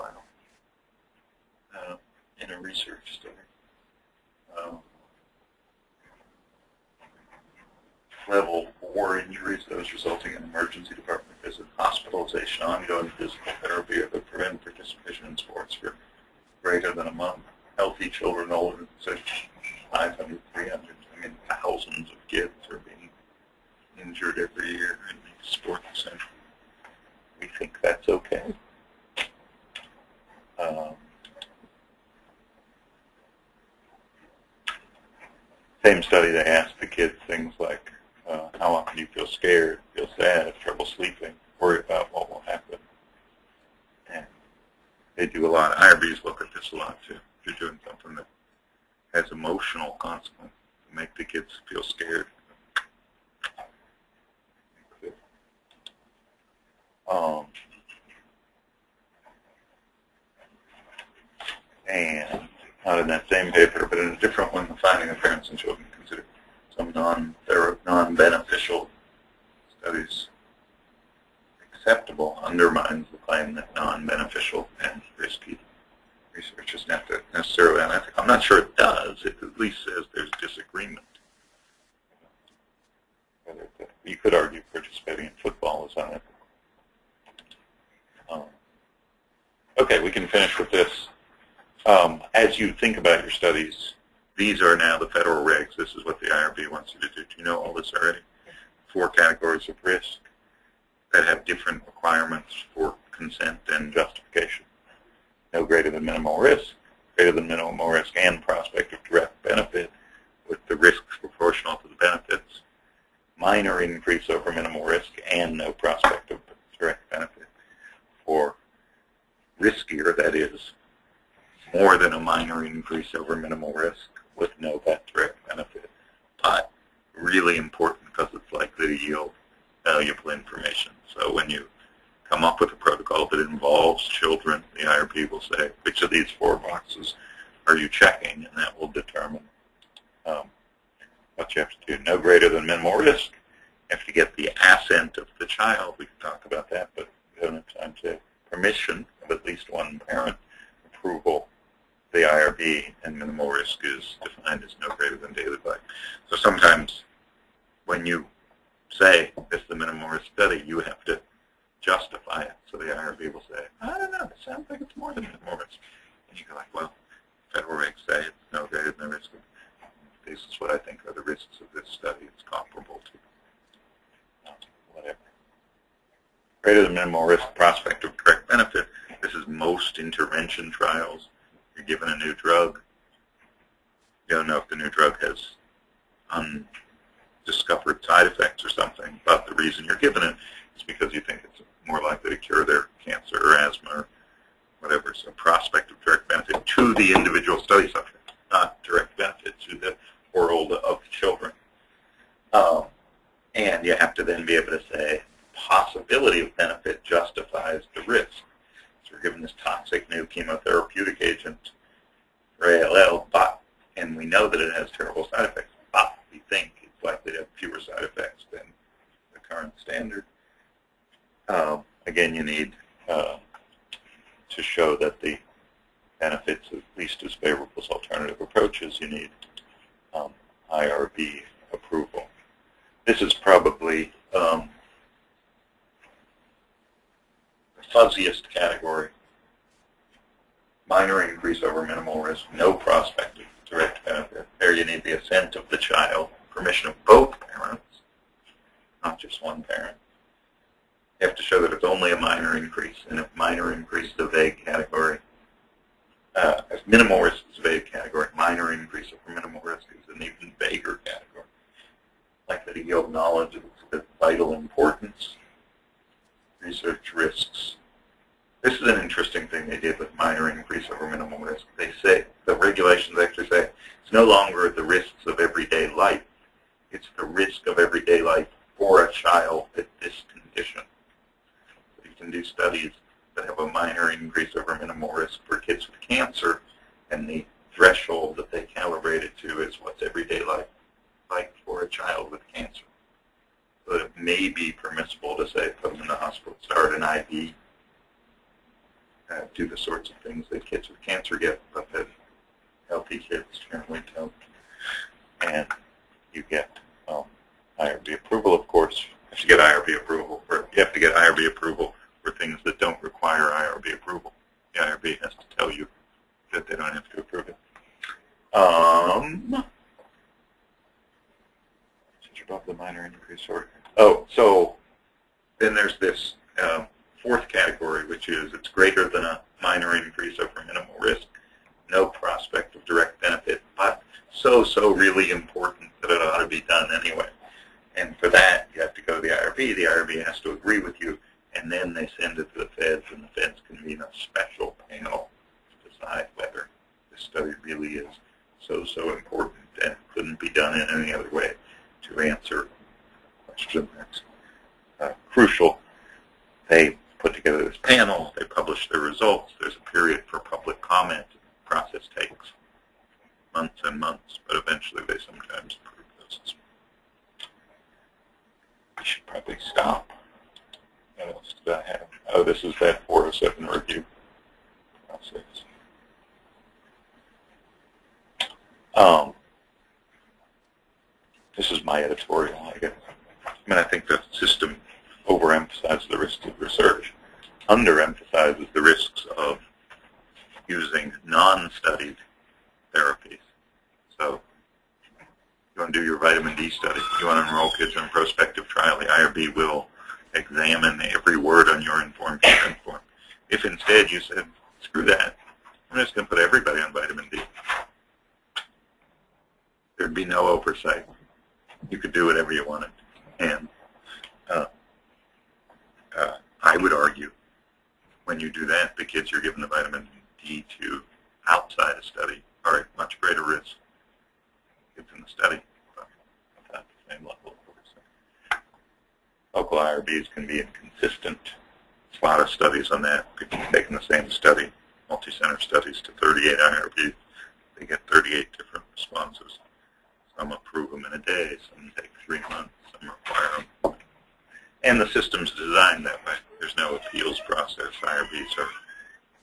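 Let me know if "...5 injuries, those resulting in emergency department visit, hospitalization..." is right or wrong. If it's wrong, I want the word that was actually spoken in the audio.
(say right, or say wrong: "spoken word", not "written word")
wrong: "4", not "5".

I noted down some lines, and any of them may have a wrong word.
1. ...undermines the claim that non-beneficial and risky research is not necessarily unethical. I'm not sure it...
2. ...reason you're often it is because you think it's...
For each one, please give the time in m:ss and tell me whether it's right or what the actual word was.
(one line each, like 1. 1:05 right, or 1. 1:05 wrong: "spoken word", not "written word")
1. 1:12 right
2. 3:09 wrong: "given", not "often".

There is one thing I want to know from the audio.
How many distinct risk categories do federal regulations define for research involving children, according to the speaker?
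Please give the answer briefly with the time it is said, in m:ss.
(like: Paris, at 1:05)
4, at 1:38.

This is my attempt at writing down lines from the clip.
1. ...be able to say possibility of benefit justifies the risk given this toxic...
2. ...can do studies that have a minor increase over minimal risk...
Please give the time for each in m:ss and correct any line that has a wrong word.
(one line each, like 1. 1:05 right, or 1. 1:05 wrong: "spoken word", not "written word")
1. 3:24 right
2. 4:42 right.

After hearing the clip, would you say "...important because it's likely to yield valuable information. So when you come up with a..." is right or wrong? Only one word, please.
right.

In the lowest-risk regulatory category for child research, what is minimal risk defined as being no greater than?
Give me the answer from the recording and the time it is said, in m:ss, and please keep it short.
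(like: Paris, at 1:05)
daily play, at 2:35.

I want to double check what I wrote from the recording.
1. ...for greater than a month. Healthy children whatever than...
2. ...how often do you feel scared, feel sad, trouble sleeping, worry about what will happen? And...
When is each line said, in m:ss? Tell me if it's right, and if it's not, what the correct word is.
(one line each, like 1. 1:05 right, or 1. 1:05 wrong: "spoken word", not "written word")
1. 0:15 wrong: "older", not "whatever"
2. 0:38 right.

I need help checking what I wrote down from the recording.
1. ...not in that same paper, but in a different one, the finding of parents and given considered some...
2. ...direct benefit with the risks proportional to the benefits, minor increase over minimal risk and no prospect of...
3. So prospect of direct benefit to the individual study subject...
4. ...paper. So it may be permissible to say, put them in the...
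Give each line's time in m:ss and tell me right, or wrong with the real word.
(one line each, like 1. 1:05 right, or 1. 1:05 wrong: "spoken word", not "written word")
1. 1:02 wrong: "children", not "given"
2. 1:49 right
3. 3:15 right
4. 4:52 wrong: "cancer", not "paper".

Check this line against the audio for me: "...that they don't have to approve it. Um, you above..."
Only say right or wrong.
right.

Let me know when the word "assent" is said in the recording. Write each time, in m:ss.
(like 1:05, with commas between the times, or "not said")
2:24, 4:05.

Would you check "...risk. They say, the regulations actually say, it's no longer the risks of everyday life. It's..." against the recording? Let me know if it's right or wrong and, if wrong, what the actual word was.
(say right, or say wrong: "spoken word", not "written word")
right.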